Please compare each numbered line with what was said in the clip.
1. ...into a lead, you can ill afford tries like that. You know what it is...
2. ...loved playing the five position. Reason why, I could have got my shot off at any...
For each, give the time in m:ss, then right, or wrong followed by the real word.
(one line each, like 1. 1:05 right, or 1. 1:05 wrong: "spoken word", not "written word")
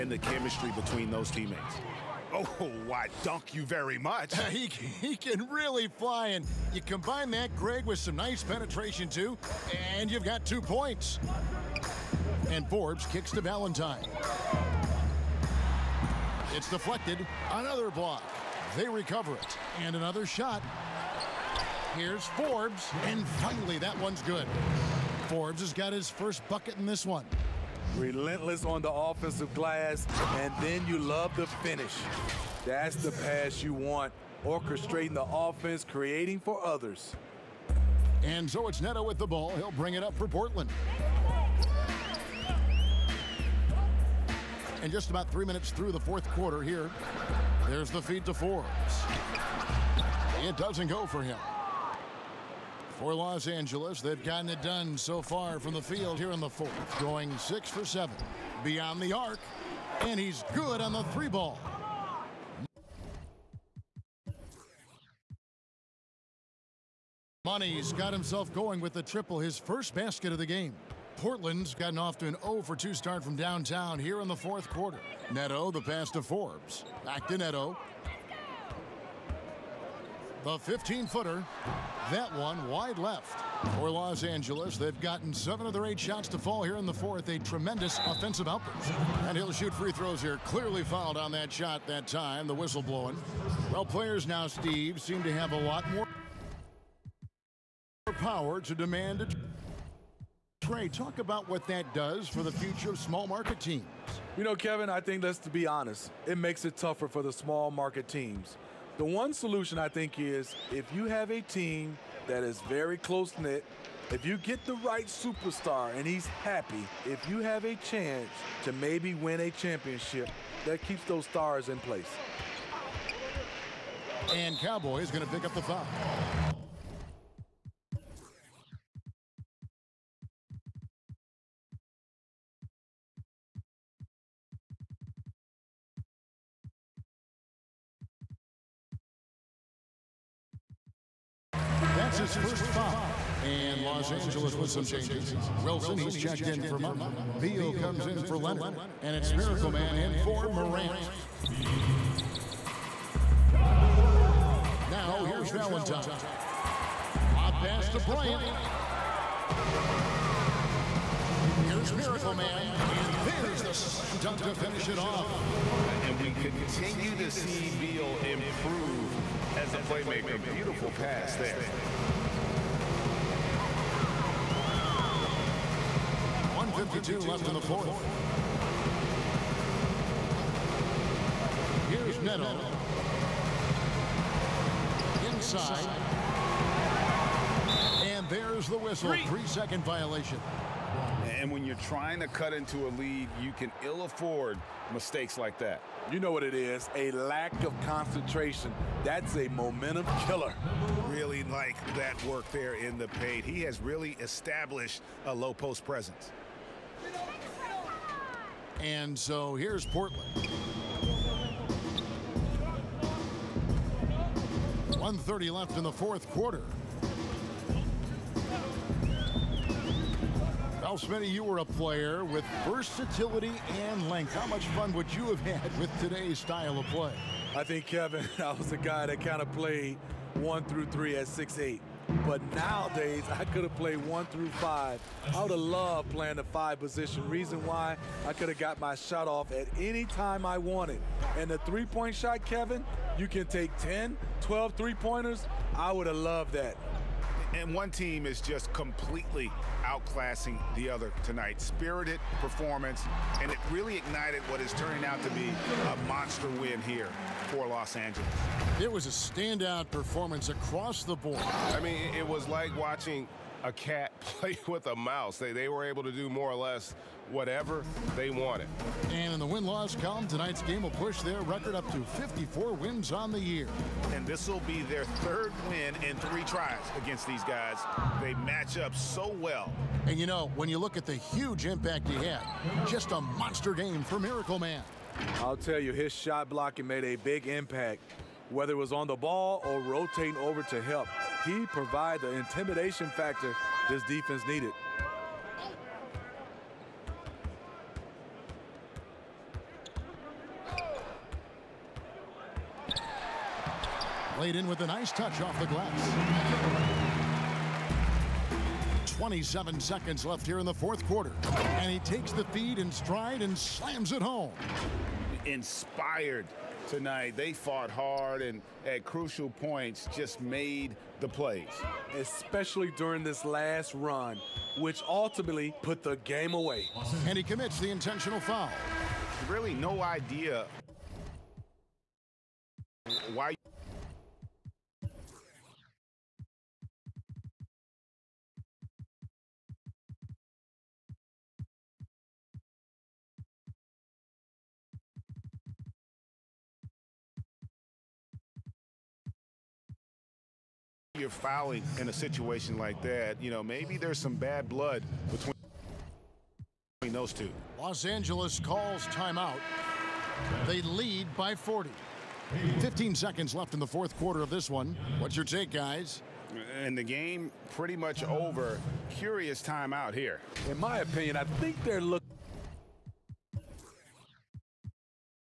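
1. 3:12 wrong: "mistakes", not "tries"
2. 3:55 right.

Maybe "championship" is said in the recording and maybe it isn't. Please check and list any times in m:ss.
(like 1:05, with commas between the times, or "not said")
1:59.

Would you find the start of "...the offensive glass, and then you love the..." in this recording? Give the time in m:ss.
0:28.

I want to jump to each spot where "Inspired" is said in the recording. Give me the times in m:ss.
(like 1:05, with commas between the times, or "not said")
5:15.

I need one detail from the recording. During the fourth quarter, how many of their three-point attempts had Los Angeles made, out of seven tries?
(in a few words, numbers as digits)
6.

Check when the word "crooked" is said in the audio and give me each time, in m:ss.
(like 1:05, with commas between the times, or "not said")
not said.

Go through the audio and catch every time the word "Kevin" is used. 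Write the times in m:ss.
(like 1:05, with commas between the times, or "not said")
1:44, 3:47, 4:02.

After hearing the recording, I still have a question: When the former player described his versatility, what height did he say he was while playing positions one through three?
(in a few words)
6'8".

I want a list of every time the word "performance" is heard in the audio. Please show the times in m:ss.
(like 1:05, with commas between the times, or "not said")
4:12, 4:19.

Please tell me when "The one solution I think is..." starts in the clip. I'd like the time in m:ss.
1:48.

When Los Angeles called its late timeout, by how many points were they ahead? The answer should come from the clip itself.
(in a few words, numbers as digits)
40.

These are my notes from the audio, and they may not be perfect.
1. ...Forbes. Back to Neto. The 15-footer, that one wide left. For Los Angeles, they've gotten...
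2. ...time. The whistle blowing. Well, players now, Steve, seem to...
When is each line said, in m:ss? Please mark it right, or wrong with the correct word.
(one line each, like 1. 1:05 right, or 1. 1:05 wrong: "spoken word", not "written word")
1. 1:16 right
2. 1:32 right.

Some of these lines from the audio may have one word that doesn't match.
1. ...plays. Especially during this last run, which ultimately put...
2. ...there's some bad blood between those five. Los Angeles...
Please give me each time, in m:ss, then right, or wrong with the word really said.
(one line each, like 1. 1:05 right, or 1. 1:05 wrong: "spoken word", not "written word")
1. 5:21 right
2. 5:53 wrong: "two", not "five".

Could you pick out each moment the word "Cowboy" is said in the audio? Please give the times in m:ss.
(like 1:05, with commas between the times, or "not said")
2:04.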